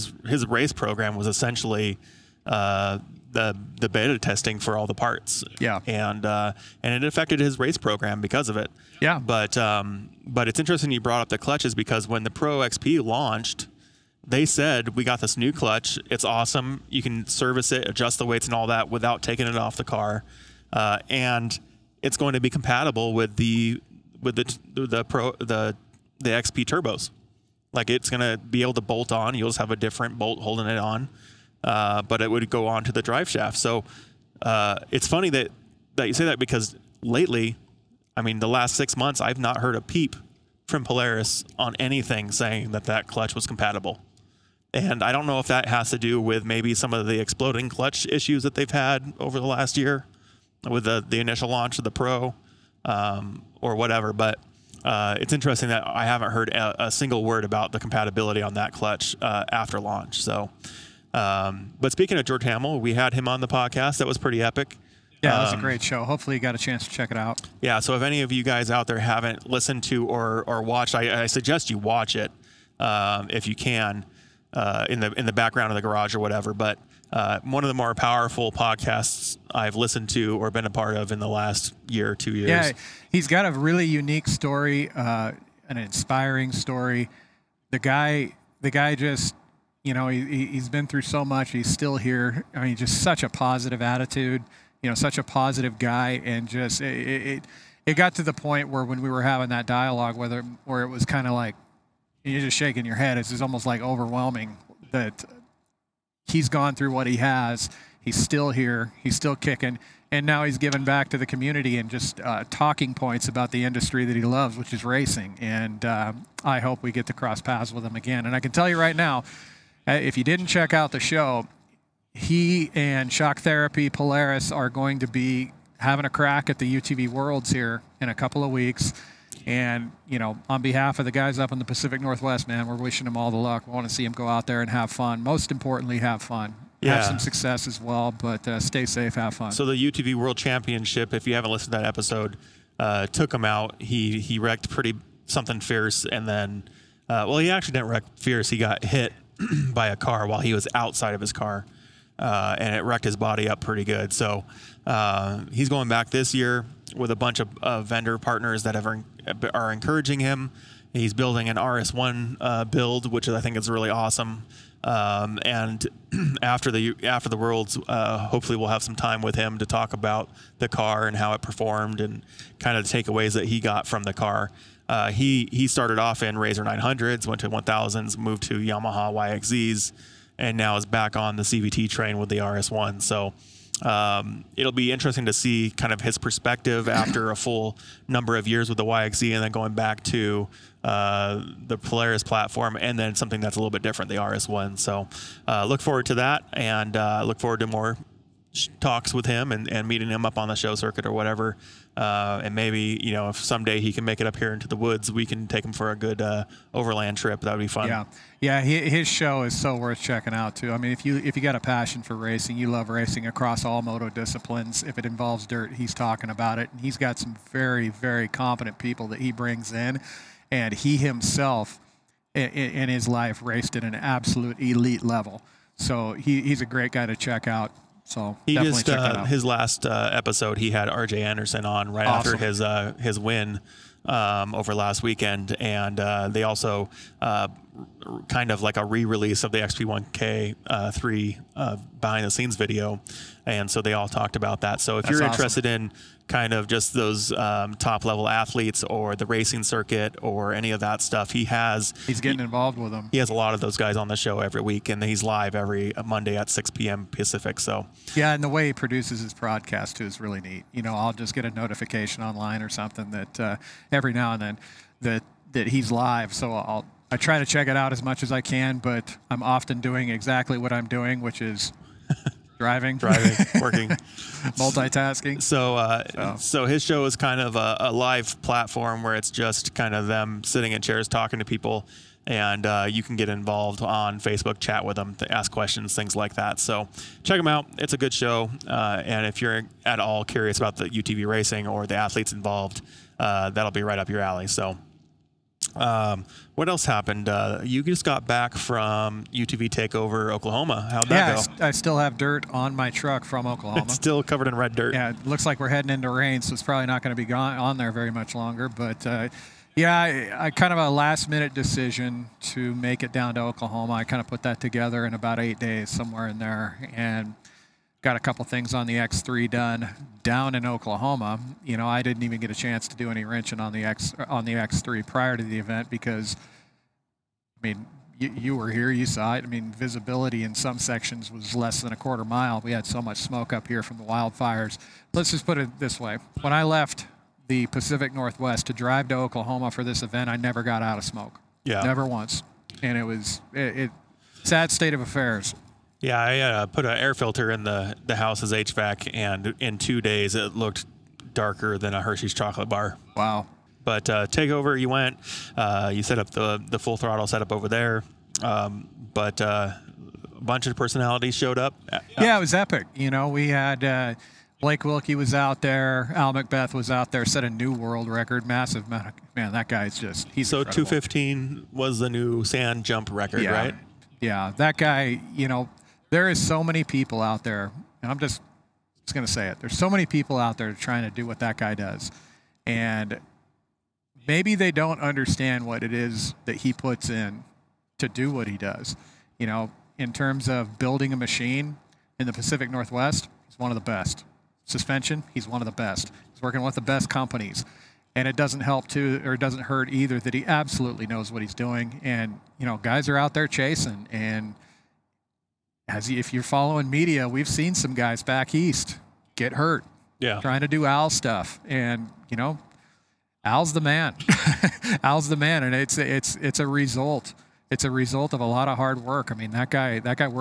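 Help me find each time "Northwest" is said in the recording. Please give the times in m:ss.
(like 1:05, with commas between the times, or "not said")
2:11, 5:38, 6:32.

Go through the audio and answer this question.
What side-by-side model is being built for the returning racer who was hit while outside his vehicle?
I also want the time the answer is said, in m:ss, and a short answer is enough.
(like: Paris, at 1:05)
RS1, at 2:41.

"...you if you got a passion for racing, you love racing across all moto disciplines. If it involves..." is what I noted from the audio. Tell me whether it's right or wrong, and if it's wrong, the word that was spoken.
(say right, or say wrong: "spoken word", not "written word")
right.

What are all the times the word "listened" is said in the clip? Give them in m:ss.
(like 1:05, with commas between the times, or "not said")
1:09, 1:19, 2:21.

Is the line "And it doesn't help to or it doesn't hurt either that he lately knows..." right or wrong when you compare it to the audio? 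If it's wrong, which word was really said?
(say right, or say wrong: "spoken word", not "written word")
wrong: "absolutely", not "lately".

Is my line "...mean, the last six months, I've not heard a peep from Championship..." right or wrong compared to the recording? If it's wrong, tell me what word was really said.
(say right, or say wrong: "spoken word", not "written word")
wrong: "Polaris", not "Championship".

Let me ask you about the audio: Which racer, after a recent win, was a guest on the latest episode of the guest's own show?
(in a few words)
R.J. Anderson.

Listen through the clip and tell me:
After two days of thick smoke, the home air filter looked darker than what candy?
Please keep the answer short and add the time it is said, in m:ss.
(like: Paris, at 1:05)
Hershey's chocolate bar, at 5:52.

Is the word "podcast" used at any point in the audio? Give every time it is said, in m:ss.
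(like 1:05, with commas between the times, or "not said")
1:03, 1:18.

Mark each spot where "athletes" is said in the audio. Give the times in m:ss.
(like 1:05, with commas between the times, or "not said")
4:08, 4:51.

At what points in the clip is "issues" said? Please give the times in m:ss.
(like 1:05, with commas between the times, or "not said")
0:48.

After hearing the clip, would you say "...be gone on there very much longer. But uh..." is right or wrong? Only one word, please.
right.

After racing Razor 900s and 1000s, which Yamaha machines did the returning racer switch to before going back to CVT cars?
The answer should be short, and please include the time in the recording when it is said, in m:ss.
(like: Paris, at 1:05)
Yamaha YXZs, at 2:58.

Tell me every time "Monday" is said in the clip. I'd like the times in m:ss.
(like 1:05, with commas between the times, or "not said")
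4:16.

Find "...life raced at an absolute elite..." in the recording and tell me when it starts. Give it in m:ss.
3:43.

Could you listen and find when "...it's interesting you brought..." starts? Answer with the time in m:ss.
0:10.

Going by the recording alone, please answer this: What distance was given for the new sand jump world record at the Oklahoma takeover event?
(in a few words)
215.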